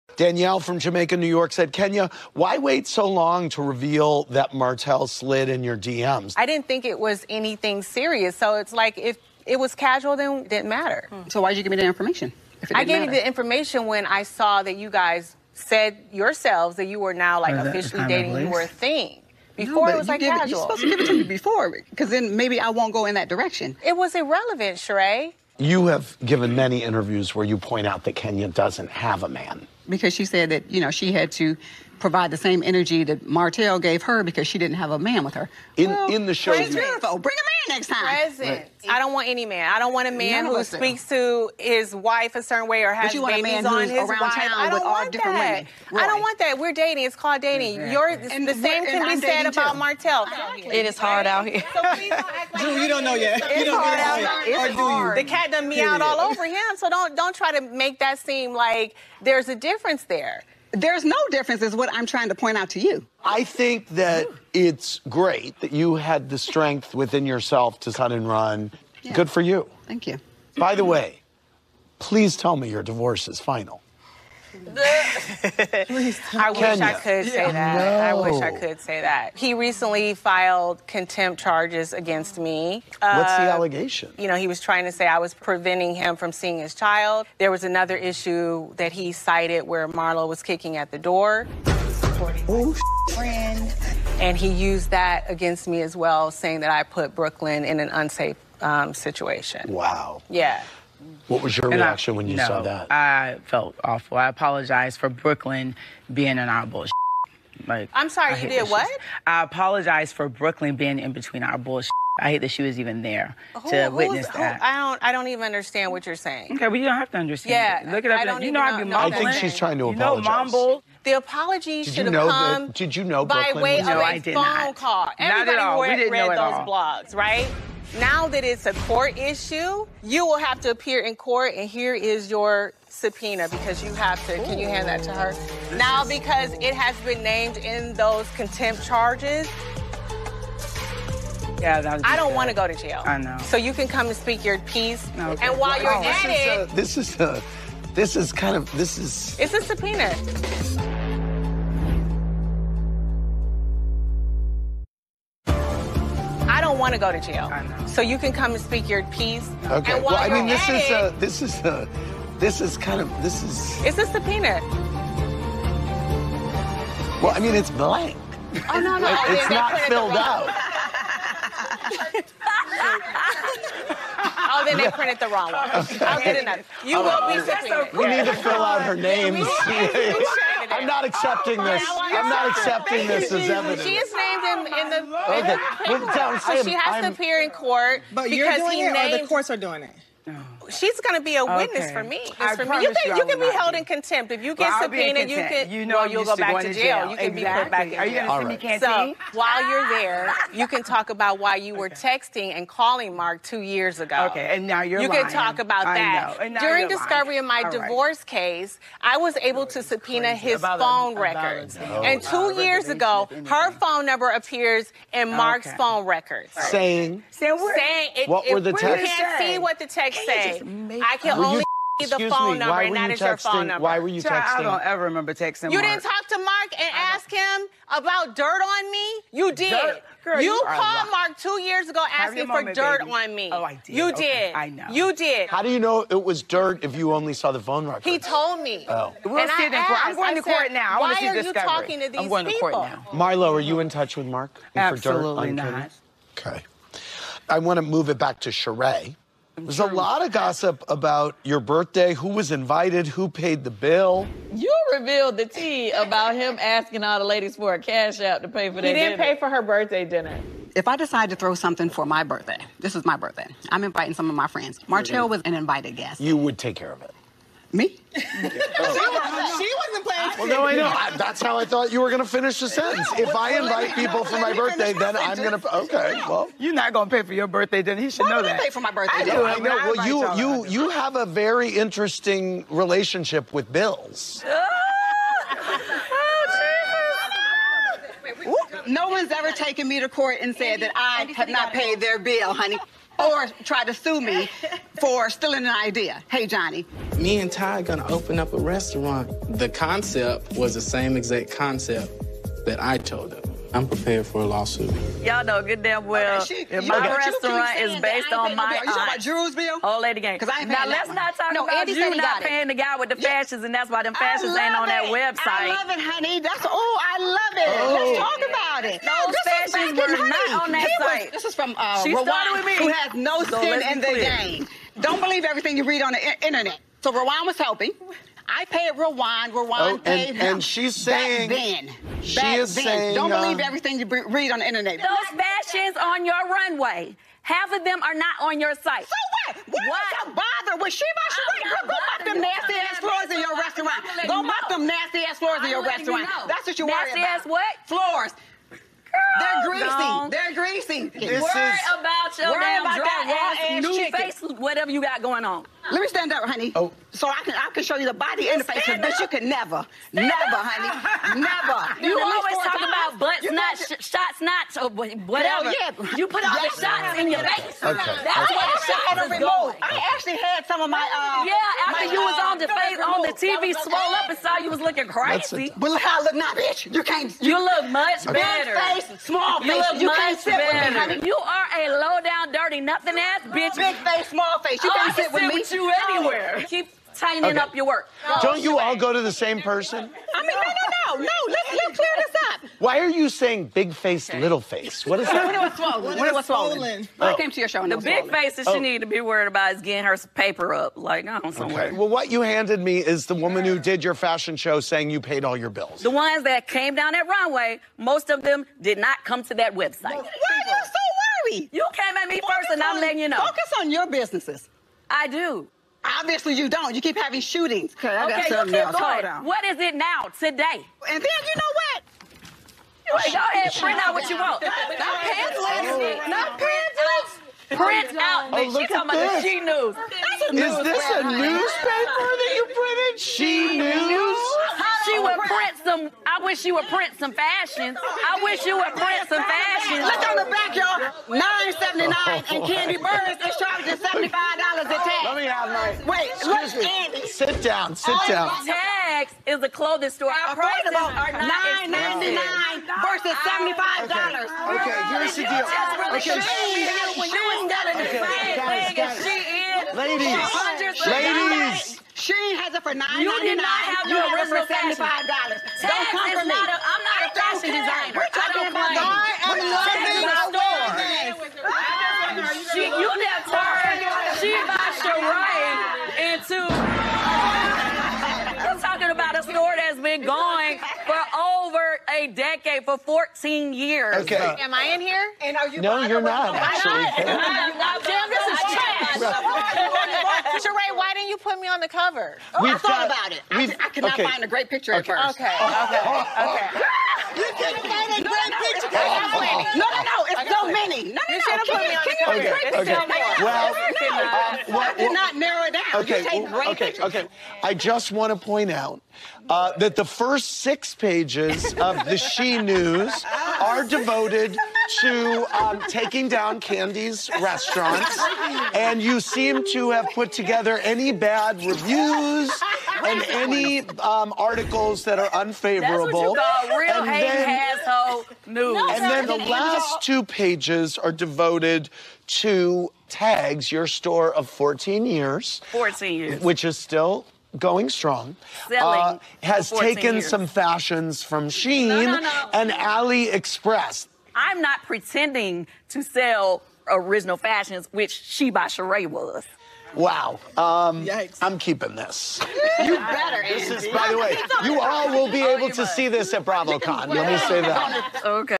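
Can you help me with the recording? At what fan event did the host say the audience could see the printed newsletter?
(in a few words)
BravoCon.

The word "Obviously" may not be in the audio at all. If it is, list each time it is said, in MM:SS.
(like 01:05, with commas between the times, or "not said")
06:56.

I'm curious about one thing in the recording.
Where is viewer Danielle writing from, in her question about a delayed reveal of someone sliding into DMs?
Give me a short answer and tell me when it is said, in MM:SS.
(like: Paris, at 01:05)
Jamaica, New York, at 00:00.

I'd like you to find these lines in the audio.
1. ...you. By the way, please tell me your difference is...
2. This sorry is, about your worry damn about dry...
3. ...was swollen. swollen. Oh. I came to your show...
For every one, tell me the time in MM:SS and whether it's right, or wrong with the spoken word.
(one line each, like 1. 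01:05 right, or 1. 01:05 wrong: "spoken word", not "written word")
1. 01:10 wrong: "divorce", not "difference"
2. 05:50 wrong: "worry", not "sorry"
3. 06:36 right.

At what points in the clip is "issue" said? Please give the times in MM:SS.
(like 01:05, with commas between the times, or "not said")
01:27, 02:09.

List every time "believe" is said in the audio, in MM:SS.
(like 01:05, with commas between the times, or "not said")
05:25, 05:33.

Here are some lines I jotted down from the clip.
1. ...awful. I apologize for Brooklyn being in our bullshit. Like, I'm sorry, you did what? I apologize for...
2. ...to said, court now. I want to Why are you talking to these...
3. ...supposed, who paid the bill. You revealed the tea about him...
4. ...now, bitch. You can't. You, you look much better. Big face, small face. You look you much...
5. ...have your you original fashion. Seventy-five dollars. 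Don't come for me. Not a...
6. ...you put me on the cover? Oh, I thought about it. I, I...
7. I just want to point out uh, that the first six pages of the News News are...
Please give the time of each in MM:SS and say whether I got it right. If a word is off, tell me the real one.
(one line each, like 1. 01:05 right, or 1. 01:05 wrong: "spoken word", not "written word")
1. 01:43 right
2. 04:00 right
3. 04:12 wrong: "invited", not "supposed"
4. 06:16 right
5. 07:43 right
6. 08:11 right
7. 08:27 wrong: "She", not "News".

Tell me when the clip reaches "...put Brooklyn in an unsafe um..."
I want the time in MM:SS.
01:36.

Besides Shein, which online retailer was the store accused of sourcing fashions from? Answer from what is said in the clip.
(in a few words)
AliExpress.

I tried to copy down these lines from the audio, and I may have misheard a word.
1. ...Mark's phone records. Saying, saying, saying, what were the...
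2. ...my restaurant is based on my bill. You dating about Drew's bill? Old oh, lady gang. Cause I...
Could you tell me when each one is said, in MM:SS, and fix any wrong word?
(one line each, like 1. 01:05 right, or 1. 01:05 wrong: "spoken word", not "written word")
1. 03:35 right
2. 05:06 wrong: "talking", not "dating".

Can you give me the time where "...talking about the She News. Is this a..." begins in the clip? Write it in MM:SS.
07:08.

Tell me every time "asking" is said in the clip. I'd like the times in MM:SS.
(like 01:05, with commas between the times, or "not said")
03:52, 04:16.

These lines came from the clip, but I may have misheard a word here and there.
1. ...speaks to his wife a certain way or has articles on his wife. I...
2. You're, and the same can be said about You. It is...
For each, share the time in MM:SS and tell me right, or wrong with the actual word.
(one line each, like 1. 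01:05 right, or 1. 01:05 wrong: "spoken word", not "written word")
1. 00:40 wrong: "babies", not "articles"
2. 00:47 wrong: "Martell", not "You".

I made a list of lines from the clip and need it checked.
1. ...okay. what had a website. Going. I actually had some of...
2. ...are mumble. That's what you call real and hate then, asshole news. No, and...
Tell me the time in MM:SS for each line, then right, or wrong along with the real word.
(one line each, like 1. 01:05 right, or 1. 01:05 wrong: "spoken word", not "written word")
1. 06:08 wrong: "remote", not "website"
2. 08:45 wrong: "unfavorable", not "mumble".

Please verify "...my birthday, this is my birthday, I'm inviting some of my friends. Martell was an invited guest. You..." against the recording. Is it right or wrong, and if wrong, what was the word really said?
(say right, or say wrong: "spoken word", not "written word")
right.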